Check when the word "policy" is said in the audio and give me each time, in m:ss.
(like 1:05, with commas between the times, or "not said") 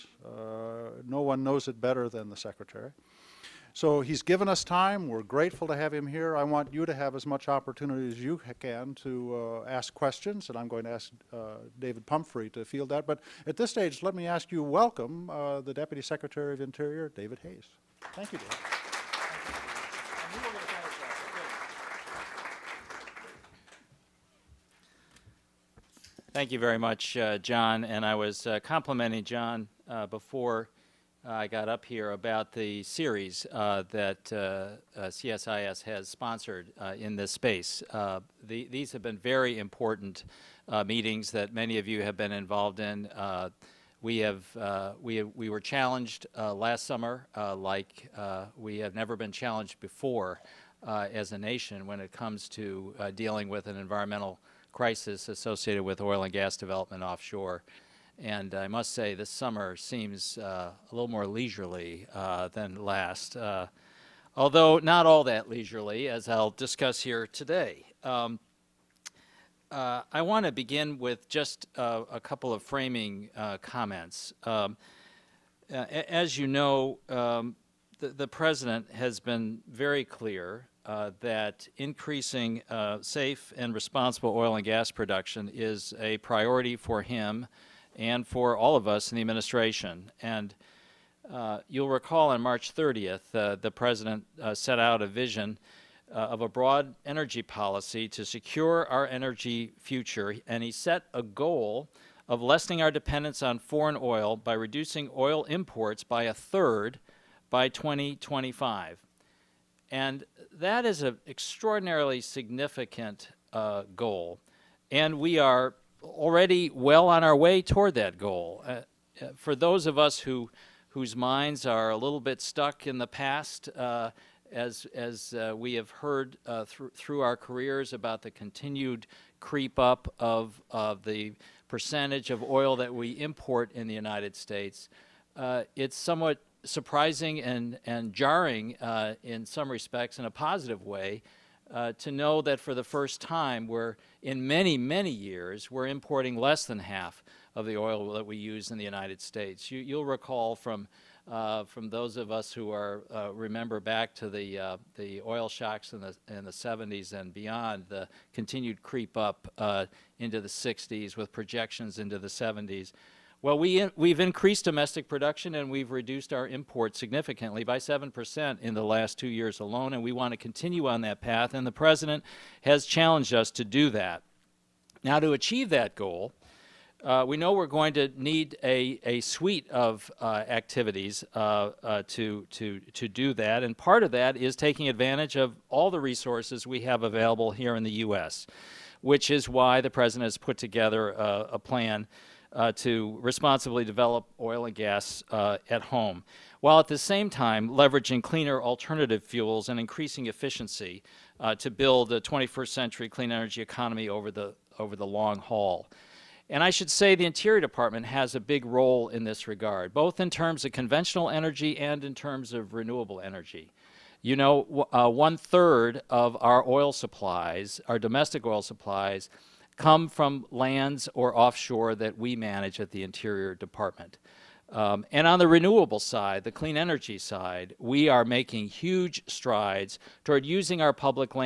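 1:37.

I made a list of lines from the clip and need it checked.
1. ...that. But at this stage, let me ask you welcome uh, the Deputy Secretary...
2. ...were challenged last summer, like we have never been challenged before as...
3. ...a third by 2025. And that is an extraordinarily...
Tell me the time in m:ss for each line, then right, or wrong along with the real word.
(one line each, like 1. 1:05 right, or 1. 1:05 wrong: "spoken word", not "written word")
1. 0:12 right
2. 0:45 right
3. 1:46 right.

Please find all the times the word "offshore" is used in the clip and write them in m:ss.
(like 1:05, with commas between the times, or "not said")
0:57, 3:41.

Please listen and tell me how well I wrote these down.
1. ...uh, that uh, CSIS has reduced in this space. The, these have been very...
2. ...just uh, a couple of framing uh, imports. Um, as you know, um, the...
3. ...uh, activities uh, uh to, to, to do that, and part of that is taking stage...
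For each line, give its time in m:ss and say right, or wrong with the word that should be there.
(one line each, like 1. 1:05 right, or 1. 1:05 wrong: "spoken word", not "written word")
1. 0:33 wrong: "sponsored", not "reduced"
2. 1:11 wrong: "comments", not "imports"
3. 3:00 wrong: "advantage", not "stage".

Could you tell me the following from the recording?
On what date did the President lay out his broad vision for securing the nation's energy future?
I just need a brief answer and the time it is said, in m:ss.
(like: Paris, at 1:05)
March 30th, at 1:32.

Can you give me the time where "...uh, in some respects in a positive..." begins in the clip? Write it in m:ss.
2:18.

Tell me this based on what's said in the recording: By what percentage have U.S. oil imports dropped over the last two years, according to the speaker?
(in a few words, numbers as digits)
7%.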